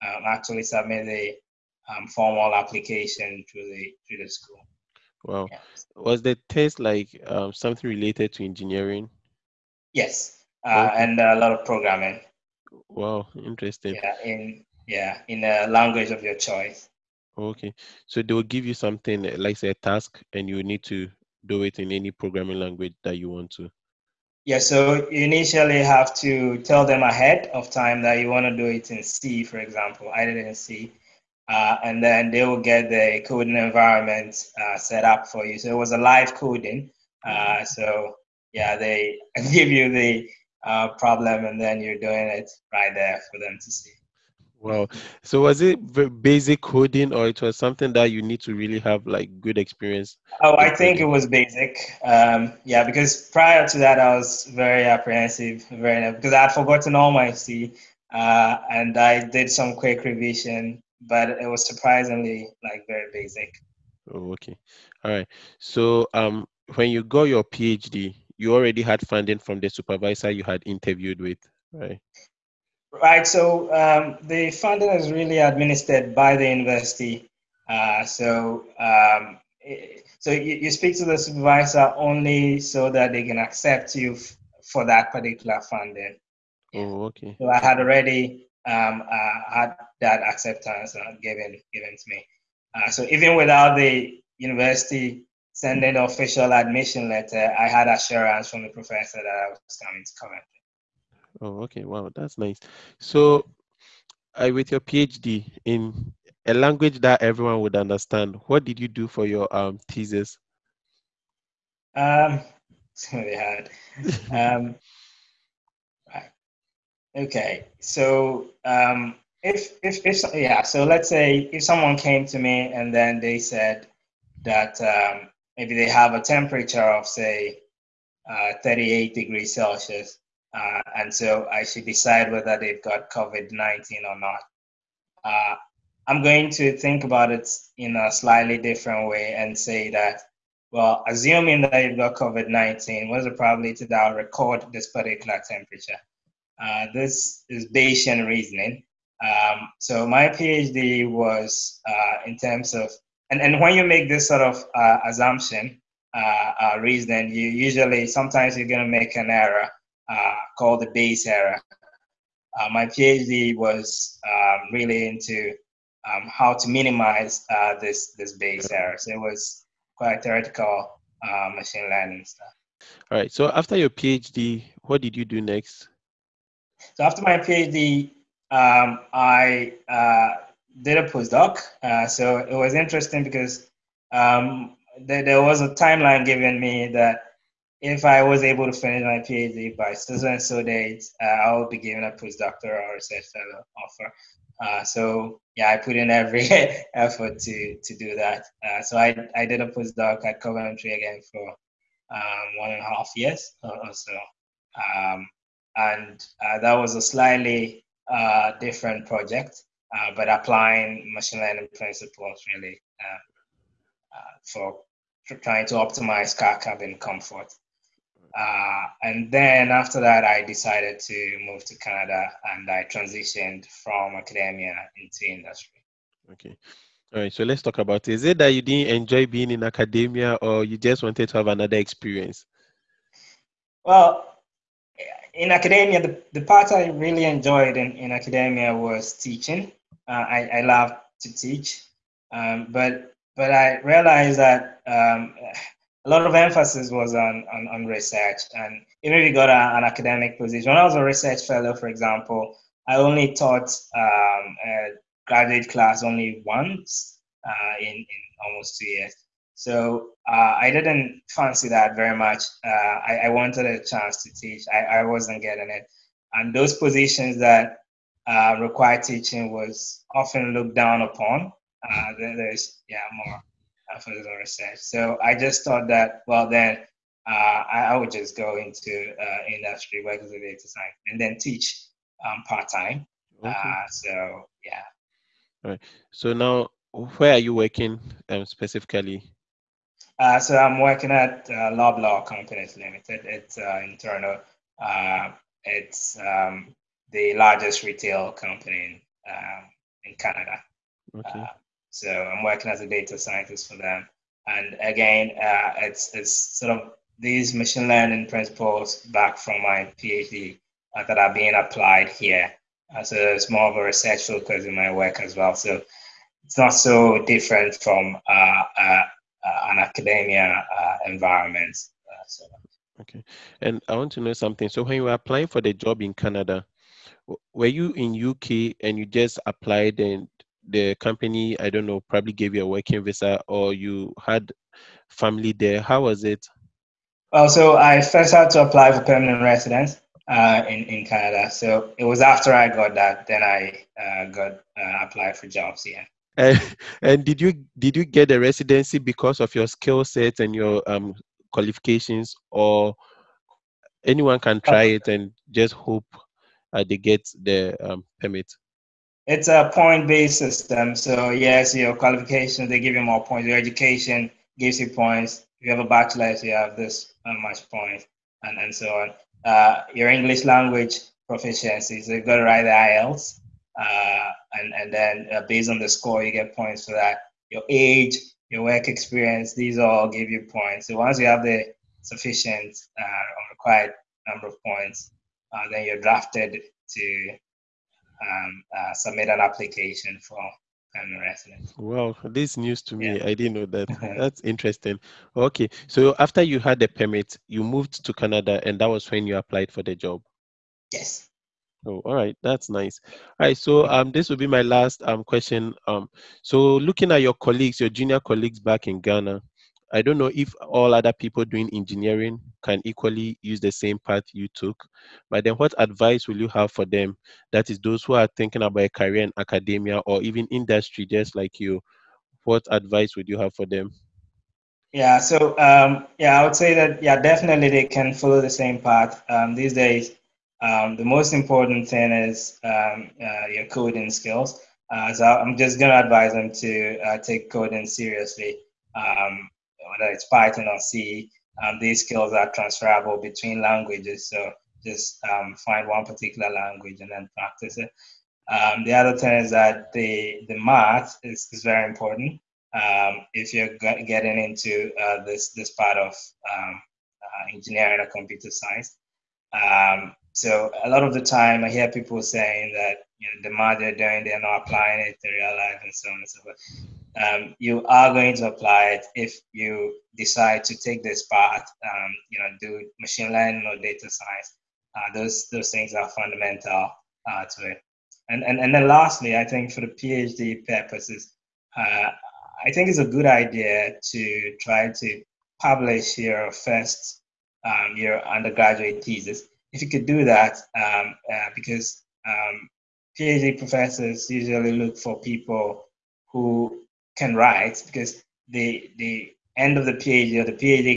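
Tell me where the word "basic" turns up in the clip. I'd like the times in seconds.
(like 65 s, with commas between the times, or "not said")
46 s, 51 s, 63 s.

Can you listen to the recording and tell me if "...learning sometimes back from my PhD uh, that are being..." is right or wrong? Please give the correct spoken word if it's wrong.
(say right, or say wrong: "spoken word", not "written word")
wrong: "principles", not "sometimes".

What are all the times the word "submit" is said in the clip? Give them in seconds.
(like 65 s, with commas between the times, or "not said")
0 s, 388 s.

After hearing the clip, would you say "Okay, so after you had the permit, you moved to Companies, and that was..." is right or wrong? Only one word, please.
wrong.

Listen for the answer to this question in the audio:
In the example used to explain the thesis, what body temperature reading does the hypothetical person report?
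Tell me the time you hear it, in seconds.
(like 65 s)
128 s.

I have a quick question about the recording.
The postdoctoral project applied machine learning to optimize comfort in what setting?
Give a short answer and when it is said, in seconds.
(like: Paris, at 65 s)
car cabin, at 216 s.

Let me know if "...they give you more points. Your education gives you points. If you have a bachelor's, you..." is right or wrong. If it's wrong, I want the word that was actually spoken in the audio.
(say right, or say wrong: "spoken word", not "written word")
right.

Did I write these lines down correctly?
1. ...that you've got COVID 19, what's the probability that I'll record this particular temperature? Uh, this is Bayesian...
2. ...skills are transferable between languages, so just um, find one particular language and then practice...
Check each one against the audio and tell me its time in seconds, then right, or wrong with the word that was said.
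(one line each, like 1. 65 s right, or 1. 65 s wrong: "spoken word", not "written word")
1. 141 s right
2. 442 s right.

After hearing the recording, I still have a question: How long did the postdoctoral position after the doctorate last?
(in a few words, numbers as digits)
one and a half years.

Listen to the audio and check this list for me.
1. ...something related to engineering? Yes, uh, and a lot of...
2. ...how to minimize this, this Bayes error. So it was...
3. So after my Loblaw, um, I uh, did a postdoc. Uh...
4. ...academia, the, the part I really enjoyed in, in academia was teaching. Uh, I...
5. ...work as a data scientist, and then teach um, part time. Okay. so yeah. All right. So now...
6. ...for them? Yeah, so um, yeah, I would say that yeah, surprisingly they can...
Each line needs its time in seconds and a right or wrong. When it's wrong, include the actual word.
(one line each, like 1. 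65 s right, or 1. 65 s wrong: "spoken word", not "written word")
1. 7 s right
2. 166 s right
3. 176 s wrong: "PhD", not "Loblaw"
4. 235 s right
5. 280 s right
6. 423 s wrong: "definitely", not "surprisingly".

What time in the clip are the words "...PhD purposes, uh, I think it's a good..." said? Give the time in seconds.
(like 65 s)
479 s.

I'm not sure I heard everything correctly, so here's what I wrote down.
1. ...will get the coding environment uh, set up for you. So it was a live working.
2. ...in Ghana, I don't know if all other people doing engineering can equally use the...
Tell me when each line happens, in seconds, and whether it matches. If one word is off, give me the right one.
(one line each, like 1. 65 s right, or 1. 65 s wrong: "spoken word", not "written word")
1. 32 s wrong: "coding", not "working"
2. 408 s right.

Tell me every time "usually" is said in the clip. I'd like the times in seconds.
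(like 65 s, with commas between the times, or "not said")
157 s, 494 s.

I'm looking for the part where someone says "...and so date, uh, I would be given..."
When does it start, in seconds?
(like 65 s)
190 s.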